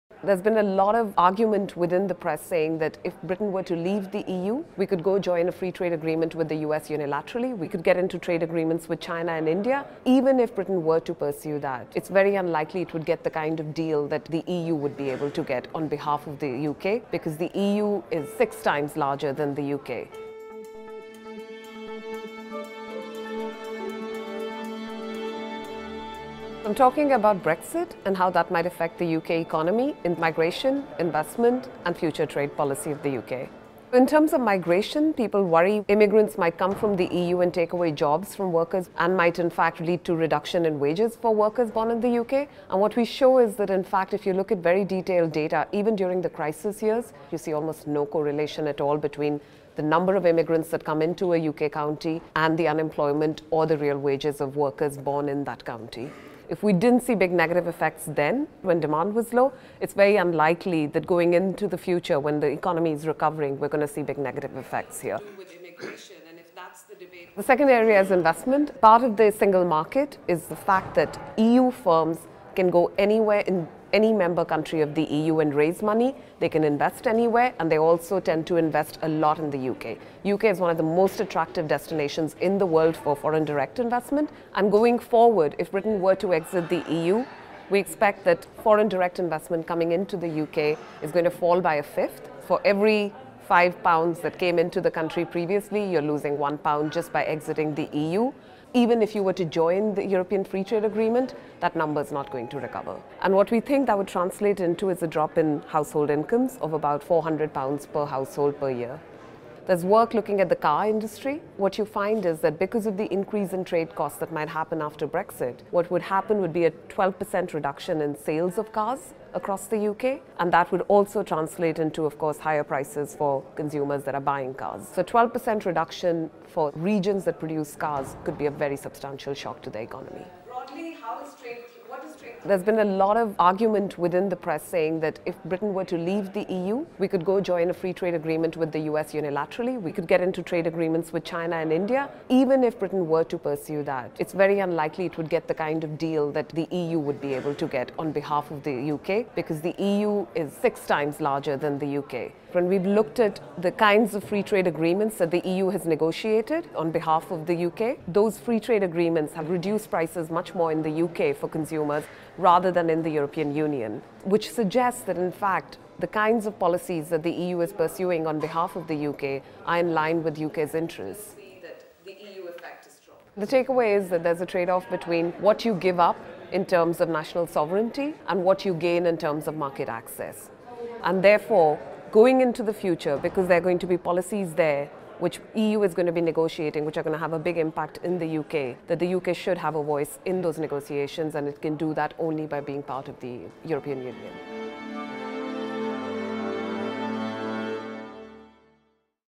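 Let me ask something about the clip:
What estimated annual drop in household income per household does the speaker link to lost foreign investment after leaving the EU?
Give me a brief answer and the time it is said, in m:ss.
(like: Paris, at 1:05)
£400, at 1:47.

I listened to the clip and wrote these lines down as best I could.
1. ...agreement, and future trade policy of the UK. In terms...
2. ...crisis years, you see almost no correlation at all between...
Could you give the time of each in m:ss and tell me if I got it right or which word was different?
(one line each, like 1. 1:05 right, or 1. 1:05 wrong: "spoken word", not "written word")
1. 0:30 wrong: "investment", not "agreement"
2. 0:46 right.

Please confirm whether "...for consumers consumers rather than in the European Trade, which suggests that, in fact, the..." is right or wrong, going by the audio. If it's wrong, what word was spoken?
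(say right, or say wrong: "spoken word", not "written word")
wrong: "Union", not "Trade".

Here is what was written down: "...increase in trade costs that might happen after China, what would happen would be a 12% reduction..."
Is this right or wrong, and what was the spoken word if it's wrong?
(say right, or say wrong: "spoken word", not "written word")
wrong: "Brexit", not "China".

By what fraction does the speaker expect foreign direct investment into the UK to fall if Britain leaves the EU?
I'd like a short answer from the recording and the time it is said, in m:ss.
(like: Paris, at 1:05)
a fifth, at 1:31.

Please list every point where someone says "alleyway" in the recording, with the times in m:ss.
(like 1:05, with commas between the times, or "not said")
not said.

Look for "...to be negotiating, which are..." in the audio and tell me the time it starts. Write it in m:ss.
3:06.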